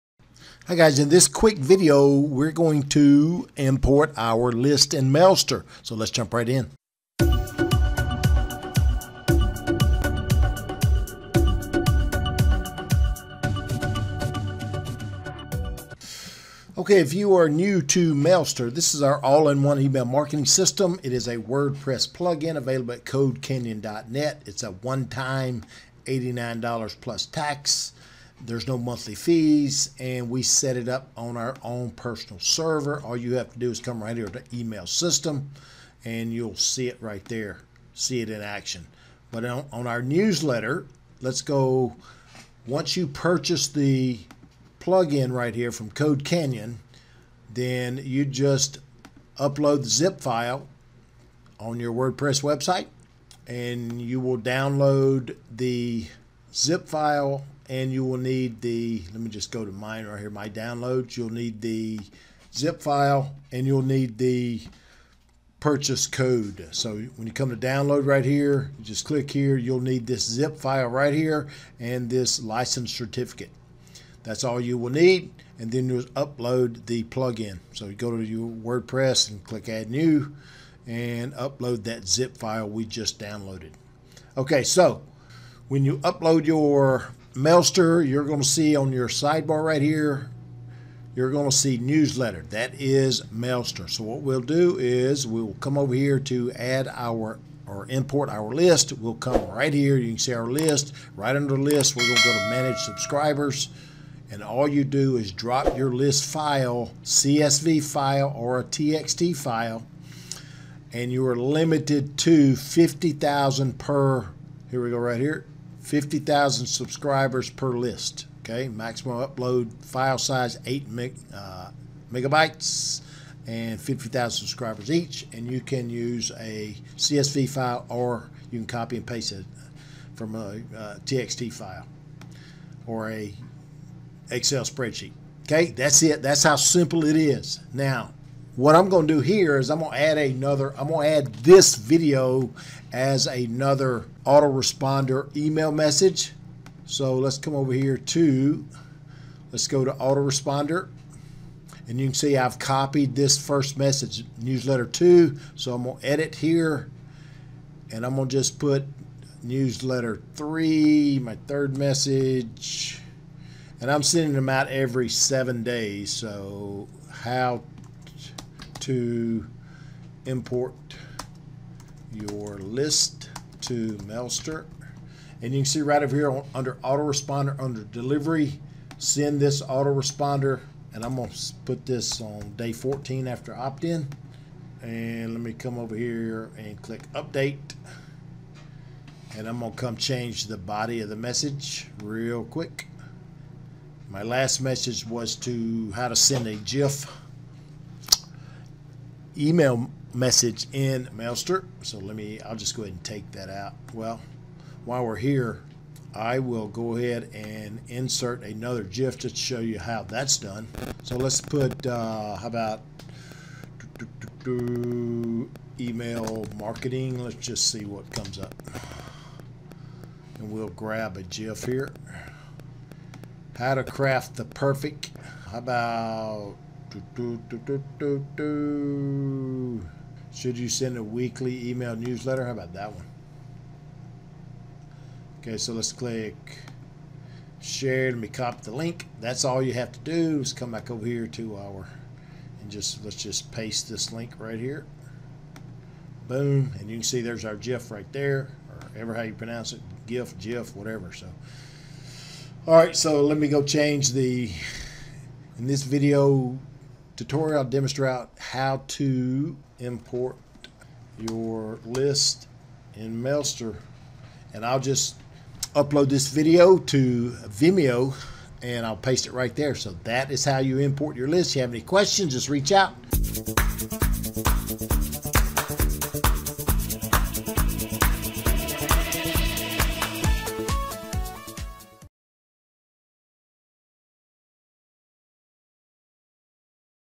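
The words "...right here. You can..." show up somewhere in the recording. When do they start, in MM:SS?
01:39.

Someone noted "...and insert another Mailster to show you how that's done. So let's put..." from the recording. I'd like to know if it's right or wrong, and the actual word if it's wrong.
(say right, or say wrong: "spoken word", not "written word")
wrong: "GIF", not "Mailster".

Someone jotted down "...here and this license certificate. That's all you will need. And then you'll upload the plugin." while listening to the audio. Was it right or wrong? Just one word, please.
right.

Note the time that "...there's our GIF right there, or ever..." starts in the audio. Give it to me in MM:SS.
04:07.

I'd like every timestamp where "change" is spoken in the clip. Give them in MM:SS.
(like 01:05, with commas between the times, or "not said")
03:09, 04:13.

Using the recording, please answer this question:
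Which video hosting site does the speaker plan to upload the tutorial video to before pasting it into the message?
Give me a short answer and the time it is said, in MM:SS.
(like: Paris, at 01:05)
Vimeo, at 04:27.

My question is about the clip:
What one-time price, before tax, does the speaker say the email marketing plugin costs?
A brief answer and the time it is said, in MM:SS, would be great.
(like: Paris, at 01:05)
$89, at 00:26.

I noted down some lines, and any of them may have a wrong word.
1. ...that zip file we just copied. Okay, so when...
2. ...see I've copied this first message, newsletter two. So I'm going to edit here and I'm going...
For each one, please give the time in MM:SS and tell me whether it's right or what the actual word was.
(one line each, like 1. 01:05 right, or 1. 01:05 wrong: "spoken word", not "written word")
1. 01:21 wrong: "downloaded", not "copied"
2. 02:32 right.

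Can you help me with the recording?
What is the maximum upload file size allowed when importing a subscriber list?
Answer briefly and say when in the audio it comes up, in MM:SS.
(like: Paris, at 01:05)
8 MB, at 02:00.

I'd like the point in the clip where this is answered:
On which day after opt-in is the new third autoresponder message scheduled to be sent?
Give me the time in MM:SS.
03:02.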